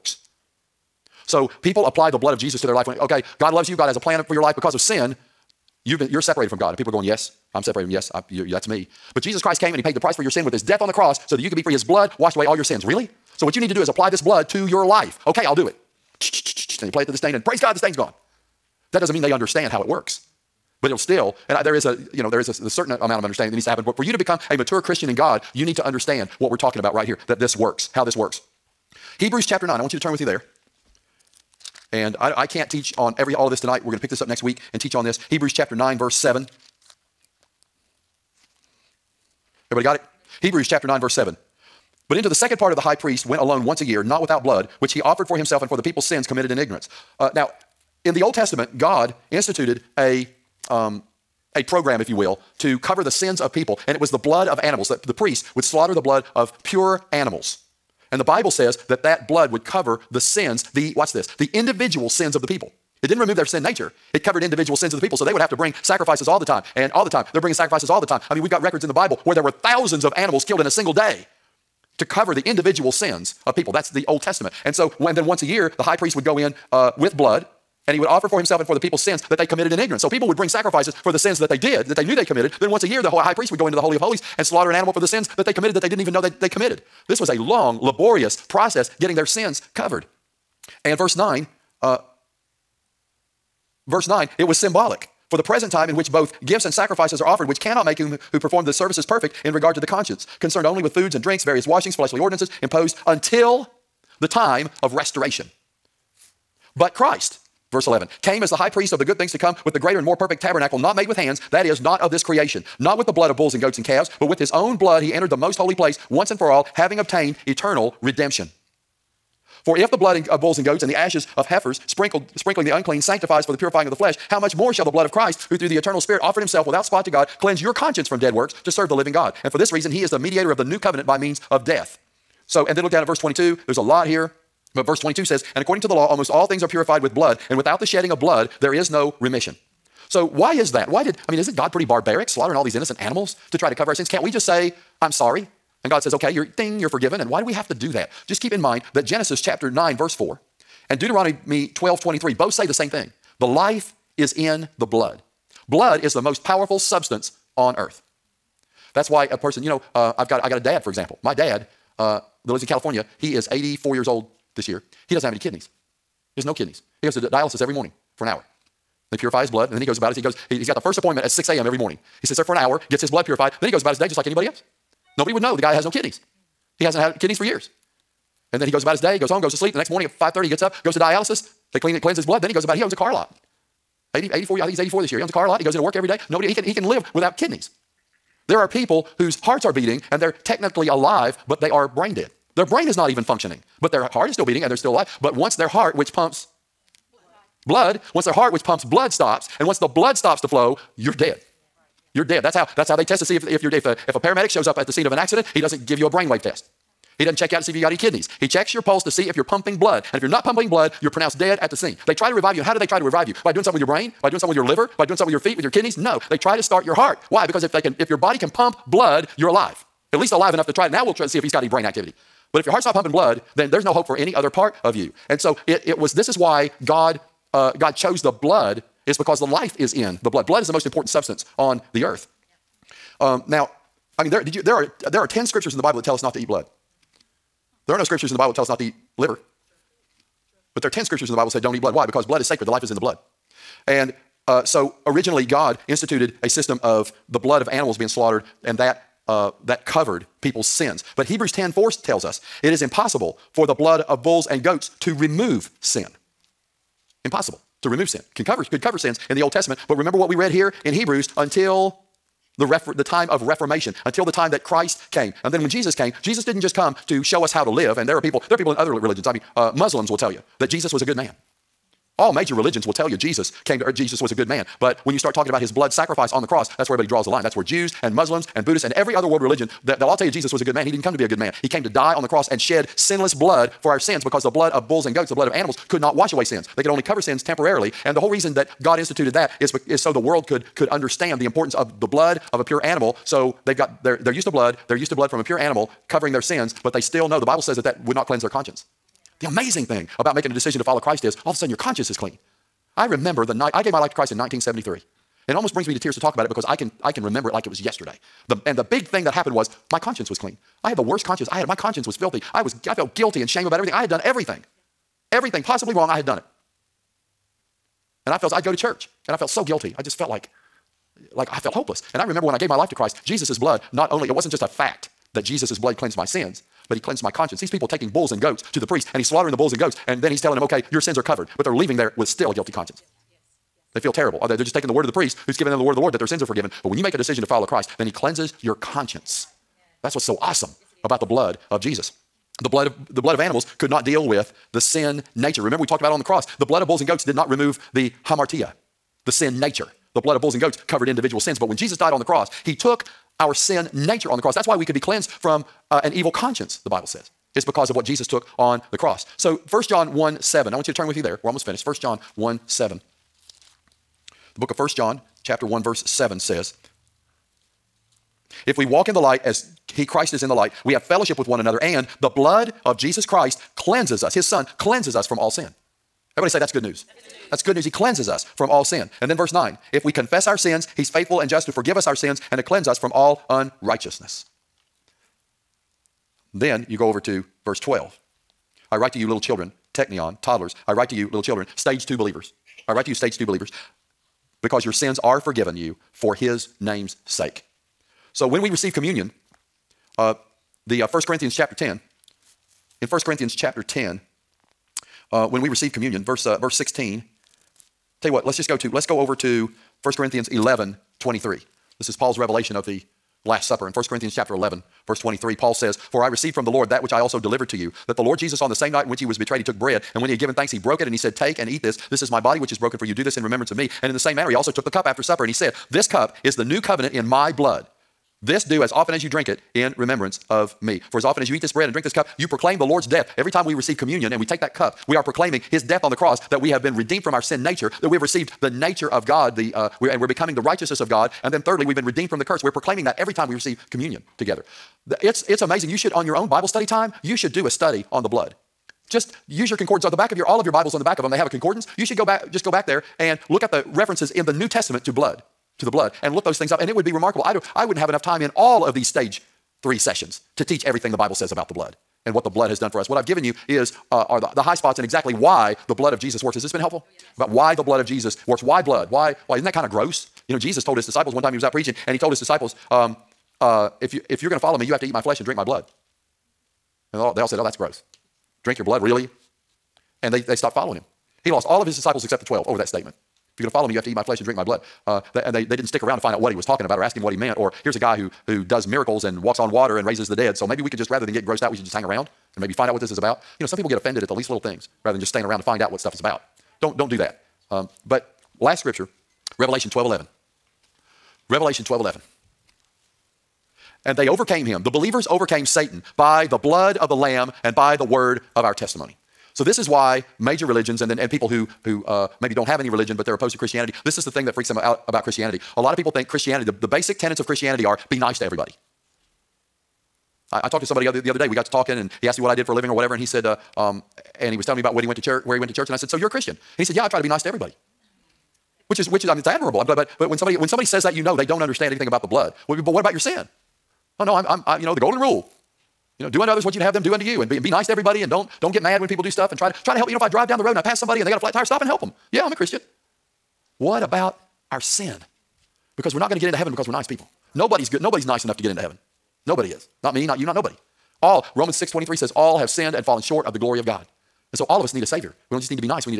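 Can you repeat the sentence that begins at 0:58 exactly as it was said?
And the Bible says that that blood would cover the sins, the, watch this, the individual sins of the people.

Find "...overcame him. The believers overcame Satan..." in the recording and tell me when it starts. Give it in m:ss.
8:24.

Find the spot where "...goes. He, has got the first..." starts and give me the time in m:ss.
2:50.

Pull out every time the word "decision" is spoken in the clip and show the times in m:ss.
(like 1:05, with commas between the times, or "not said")
5:00, 5:37.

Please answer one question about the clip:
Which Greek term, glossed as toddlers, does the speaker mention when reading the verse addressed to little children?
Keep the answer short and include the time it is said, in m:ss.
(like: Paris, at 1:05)
Teknion, at 6:29.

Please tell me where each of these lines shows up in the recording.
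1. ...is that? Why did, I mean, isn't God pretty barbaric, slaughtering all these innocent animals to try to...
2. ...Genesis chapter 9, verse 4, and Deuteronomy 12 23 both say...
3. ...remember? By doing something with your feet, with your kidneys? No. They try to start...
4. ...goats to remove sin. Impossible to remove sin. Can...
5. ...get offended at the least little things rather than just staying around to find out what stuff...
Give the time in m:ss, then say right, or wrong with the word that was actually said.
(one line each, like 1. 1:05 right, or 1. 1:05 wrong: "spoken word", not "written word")
1. 2:20 right
2. 2:29 right
3. 3:34 wrong: "liver", not "remember"
4. 4:14 right
5. 8:13 right.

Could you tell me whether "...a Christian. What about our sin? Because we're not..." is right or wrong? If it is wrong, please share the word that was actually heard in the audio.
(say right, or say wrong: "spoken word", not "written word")
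right.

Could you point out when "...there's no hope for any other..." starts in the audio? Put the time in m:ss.
3:43.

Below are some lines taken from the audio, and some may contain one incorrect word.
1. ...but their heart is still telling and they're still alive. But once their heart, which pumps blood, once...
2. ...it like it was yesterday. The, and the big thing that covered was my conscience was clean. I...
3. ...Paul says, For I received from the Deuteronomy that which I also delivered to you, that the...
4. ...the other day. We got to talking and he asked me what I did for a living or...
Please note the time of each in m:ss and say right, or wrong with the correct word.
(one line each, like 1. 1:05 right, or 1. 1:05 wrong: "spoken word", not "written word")
1. 3:13 wrong: "beating", not "telling"
2. 5:07 wrong: "happened", not "covered"
3. 6:55 wrong: "Lord", not "Deuteronomy"
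4. 8:41 right.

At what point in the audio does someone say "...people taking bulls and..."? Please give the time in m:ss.
5:27.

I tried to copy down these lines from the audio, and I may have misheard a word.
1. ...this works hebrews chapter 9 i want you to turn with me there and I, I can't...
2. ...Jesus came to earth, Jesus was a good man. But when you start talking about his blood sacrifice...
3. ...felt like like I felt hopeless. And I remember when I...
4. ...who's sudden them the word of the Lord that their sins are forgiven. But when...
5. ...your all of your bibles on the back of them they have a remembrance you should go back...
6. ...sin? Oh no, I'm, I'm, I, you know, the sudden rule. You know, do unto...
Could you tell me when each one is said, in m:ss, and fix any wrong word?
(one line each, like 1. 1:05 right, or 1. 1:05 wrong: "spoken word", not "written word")
1. 0:28 right
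2. 4:33 right
3. 5:20 right
4. 5:35 wrong: "given", not "sudden"
5. 7:30 wrong: "concordance", not "remembrance"
6. 8:53 wrong: "golden", not "sudden".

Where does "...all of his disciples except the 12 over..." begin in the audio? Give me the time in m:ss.
8:01.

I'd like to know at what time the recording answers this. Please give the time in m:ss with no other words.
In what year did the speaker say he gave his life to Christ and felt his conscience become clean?
5:04.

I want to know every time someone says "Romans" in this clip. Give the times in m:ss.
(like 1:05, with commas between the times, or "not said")
9:11.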